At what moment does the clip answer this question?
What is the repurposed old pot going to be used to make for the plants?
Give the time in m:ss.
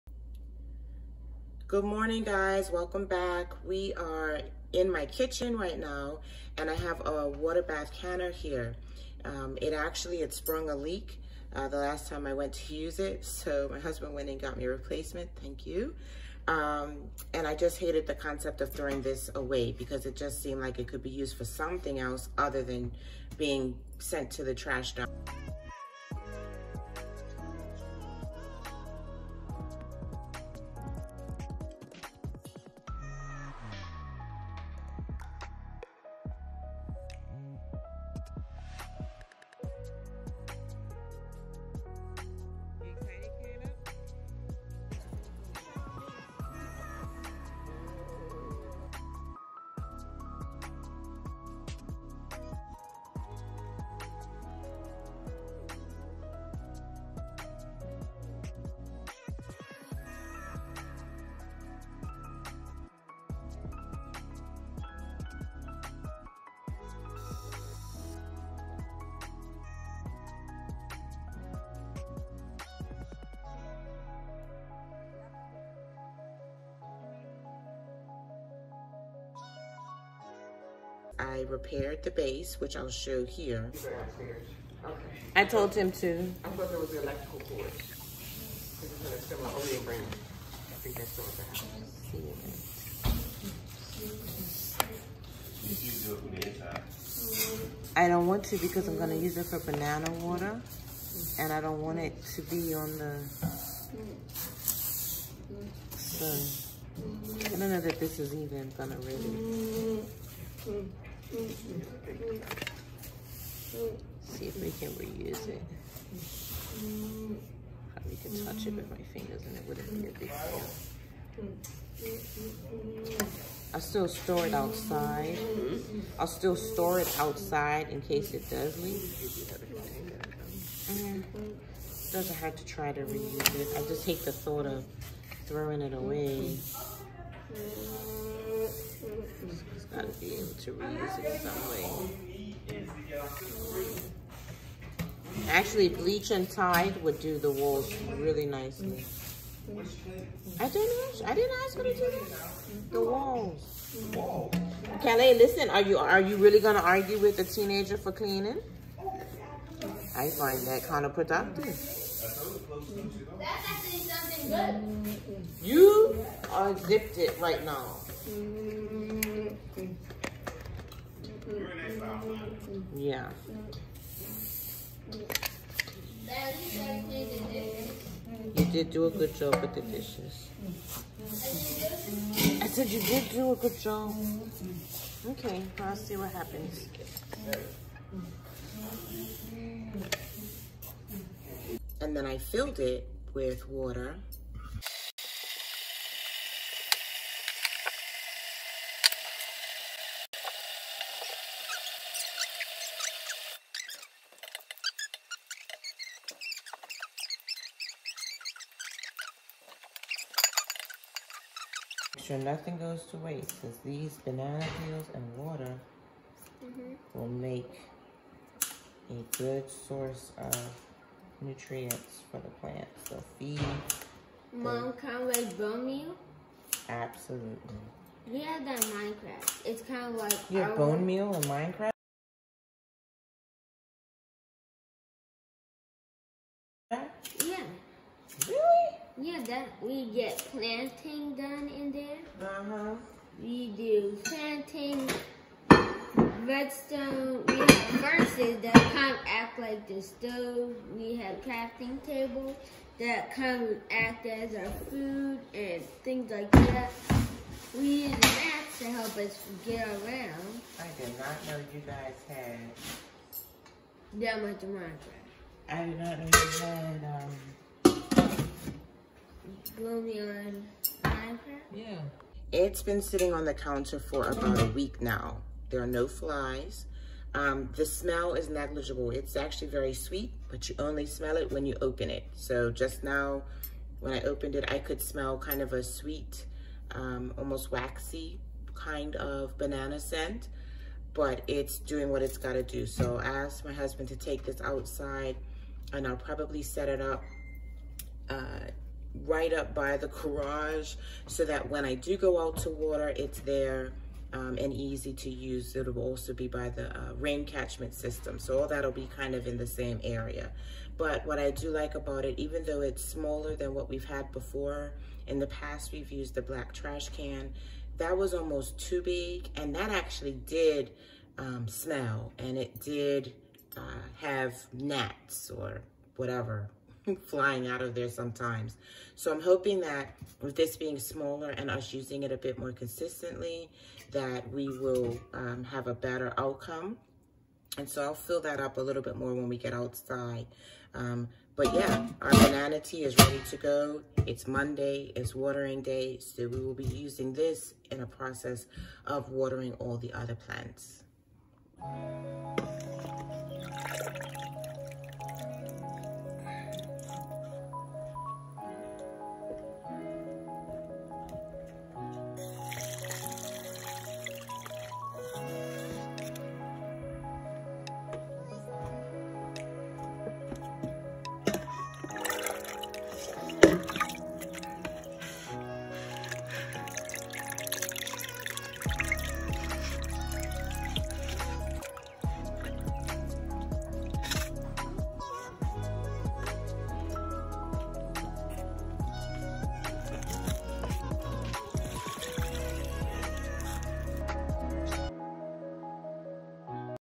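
1:39.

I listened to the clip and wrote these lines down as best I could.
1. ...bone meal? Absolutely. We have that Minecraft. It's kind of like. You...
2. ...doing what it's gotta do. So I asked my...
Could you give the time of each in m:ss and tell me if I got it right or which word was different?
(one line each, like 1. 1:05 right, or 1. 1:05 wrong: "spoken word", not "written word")
1. 3:45 right
2. 4:51 right.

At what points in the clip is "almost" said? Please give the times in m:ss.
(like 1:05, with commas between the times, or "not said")
4:47, 5:18.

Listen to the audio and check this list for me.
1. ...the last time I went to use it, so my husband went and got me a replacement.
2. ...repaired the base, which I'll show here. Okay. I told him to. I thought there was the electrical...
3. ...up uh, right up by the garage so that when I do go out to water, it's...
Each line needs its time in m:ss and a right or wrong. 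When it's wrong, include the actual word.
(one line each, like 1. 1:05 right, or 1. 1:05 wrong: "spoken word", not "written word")
1. 0:11 right
2. 1:21 right
3. 4:56 right.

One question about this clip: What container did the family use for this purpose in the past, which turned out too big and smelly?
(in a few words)
black trash can.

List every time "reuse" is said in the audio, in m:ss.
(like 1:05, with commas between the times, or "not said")
1:54, 2:13, 2:20.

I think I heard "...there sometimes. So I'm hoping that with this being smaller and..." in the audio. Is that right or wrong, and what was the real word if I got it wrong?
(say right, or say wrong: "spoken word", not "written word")
right.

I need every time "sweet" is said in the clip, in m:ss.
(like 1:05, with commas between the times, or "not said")
4:39, 4:45.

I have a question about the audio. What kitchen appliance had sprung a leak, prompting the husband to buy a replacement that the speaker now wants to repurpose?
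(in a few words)
water bath canner.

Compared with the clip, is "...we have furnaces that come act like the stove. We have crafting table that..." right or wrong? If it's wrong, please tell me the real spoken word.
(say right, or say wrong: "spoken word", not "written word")
right.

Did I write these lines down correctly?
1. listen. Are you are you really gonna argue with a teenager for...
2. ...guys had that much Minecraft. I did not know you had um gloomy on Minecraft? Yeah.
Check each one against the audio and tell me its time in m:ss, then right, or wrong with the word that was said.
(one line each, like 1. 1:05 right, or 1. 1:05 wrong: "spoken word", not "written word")
1. 2:35 right
2. 4:21 right.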